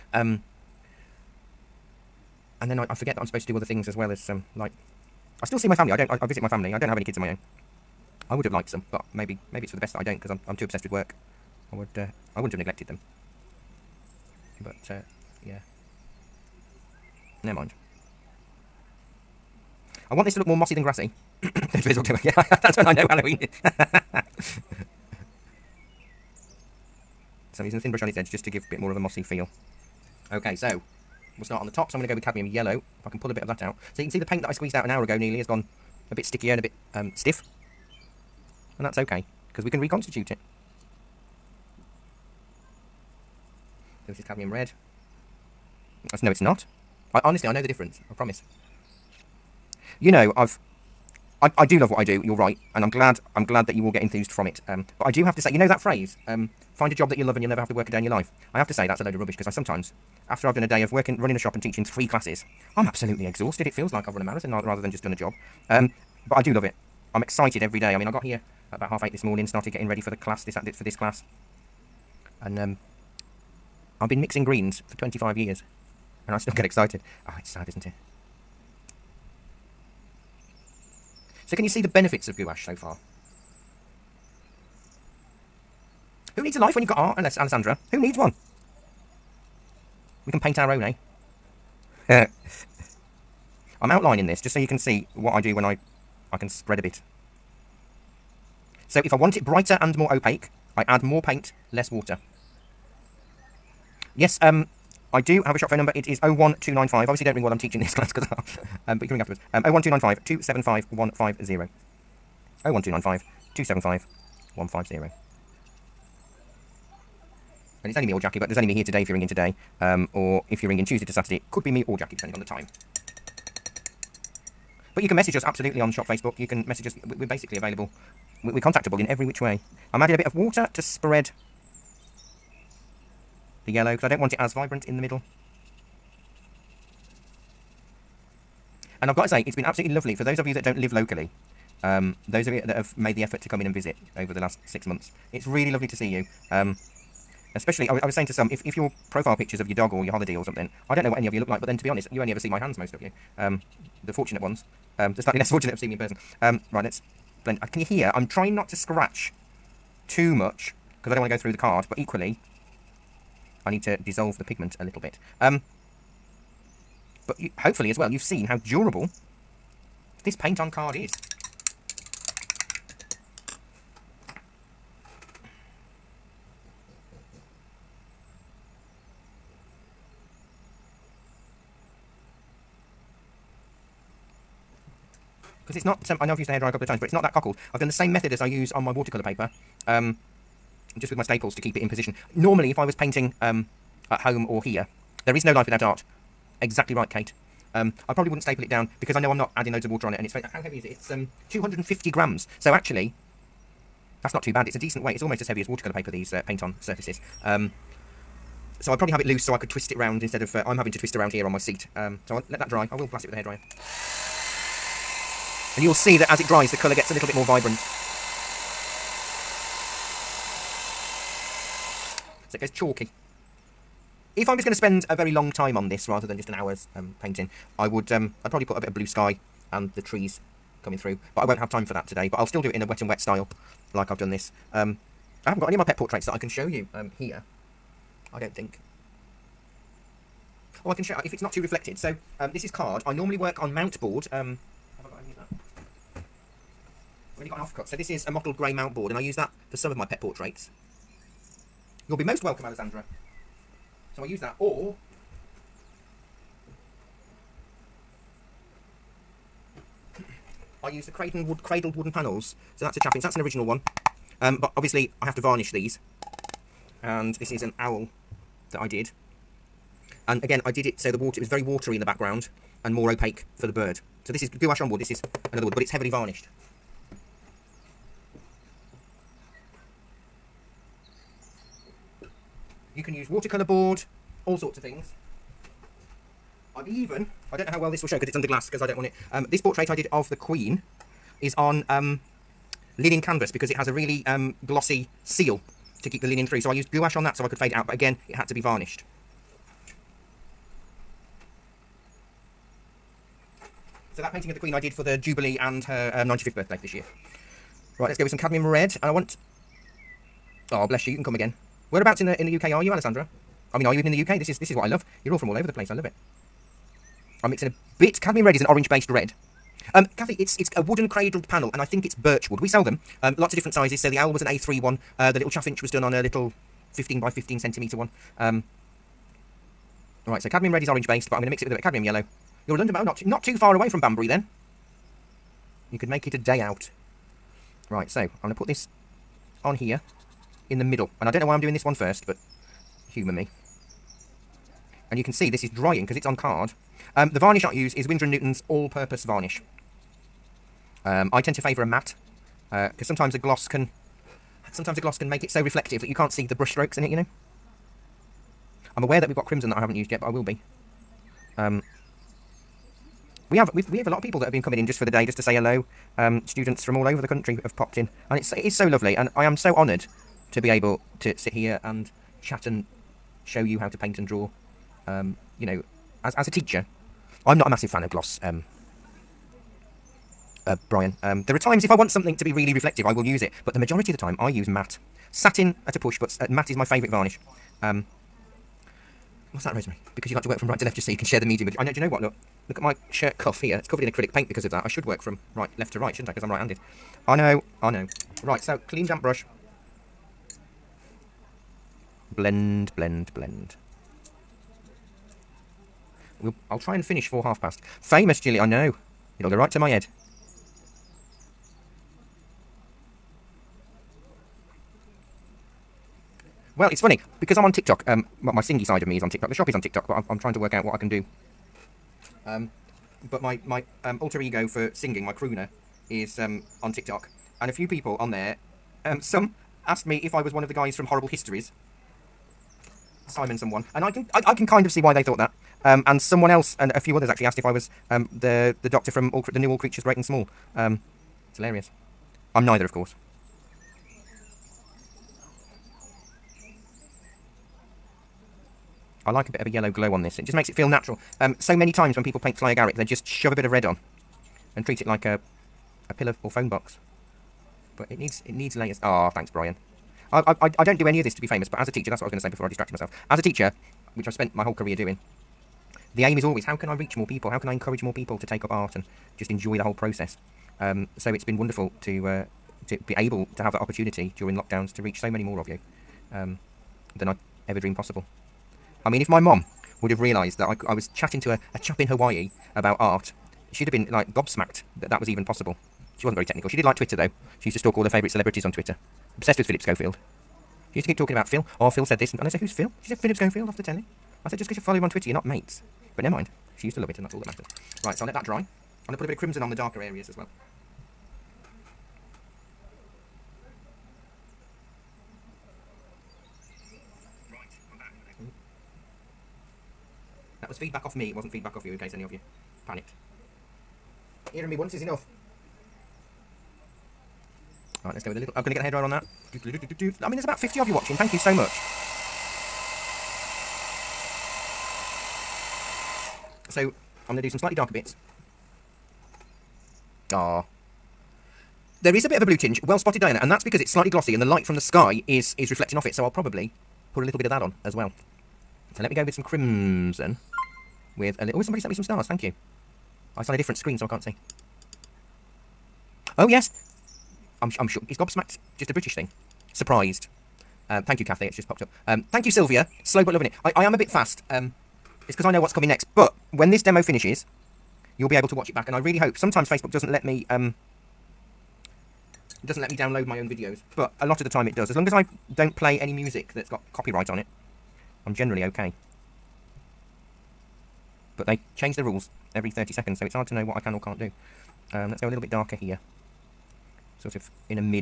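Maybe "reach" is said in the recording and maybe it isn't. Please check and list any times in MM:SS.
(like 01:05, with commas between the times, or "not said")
07:46, 07:55.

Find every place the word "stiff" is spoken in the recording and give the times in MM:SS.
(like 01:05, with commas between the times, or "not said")
00:37.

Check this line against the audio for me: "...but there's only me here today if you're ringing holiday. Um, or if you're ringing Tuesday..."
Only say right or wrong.
wrong.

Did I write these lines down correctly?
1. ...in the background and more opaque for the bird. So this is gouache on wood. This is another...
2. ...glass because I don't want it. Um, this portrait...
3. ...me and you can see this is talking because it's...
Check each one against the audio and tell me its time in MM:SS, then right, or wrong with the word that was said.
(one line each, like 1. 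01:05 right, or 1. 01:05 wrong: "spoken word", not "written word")
1. 04:31 right
2. 04:48 right
3. 05:43 wrong: "drying", not "talking".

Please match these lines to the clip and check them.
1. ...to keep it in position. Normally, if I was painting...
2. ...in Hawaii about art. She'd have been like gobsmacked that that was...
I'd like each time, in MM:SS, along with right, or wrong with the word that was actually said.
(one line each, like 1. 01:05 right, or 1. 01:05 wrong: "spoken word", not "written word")
1. 03:11 right
2. 08:02 right.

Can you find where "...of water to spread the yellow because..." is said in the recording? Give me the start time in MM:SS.
02:10.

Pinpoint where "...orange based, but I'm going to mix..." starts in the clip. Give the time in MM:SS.
05:30.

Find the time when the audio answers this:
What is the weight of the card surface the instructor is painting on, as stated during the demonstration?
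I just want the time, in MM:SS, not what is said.
03:21.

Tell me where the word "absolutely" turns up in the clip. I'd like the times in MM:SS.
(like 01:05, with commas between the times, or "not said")
01:02, 02:05, 02:19.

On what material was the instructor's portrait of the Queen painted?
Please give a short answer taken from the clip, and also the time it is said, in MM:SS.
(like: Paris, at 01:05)
Linen canvas, at 04:52.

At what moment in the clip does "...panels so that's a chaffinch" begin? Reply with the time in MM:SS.
04:22.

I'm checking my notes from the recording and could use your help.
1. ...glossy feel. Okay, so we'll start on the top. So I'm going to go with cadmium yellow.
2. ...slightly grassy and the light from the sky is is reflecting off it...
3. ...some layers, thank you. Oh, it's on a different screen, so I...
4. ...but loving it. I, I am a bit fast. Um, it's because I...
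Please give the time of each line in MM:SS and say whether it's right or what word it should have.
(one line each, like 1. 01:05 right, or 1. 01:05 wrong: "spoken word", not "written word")
1. 00:28 wrong: "mossy", not "glossy"
2. 08:53 wrong: "glossy", not "grassy"
3. 09:01 wrong: "stars", not "layers"
4. 09:13 right.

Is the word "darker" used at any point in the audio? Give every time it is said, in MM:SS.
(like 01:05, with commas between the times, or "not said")
08:19, 08:47, 09:35.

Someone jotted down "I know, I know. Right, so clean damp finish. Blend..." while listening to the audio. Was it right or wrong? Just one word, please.
wrong.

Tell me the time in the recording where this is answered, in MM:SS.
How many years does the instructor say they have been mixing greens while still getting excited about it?
01:14.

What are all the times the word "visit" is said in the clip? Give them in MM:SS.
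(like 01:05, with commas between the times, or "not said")
00:06, 02:23.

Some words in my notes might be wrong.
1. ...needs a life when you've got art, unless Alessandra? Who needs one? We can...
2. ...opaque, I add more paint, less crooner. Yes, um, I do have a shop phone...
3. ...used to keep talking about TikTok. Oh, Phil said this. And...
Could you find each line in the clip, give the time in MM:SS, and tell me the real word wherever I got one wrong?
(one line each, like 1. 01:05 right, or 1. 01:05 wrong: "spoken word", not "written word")
1. 01:26 right
2. 01:40 wrong: "water", not "crooner"
3. 08:10 wrong: "Phil", not "TikTok".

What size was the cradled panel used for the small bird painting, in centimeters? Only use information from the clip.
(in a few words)
15 by 15.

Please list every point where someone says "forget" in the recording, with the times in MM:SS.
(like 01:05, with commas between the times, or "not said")
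00:02.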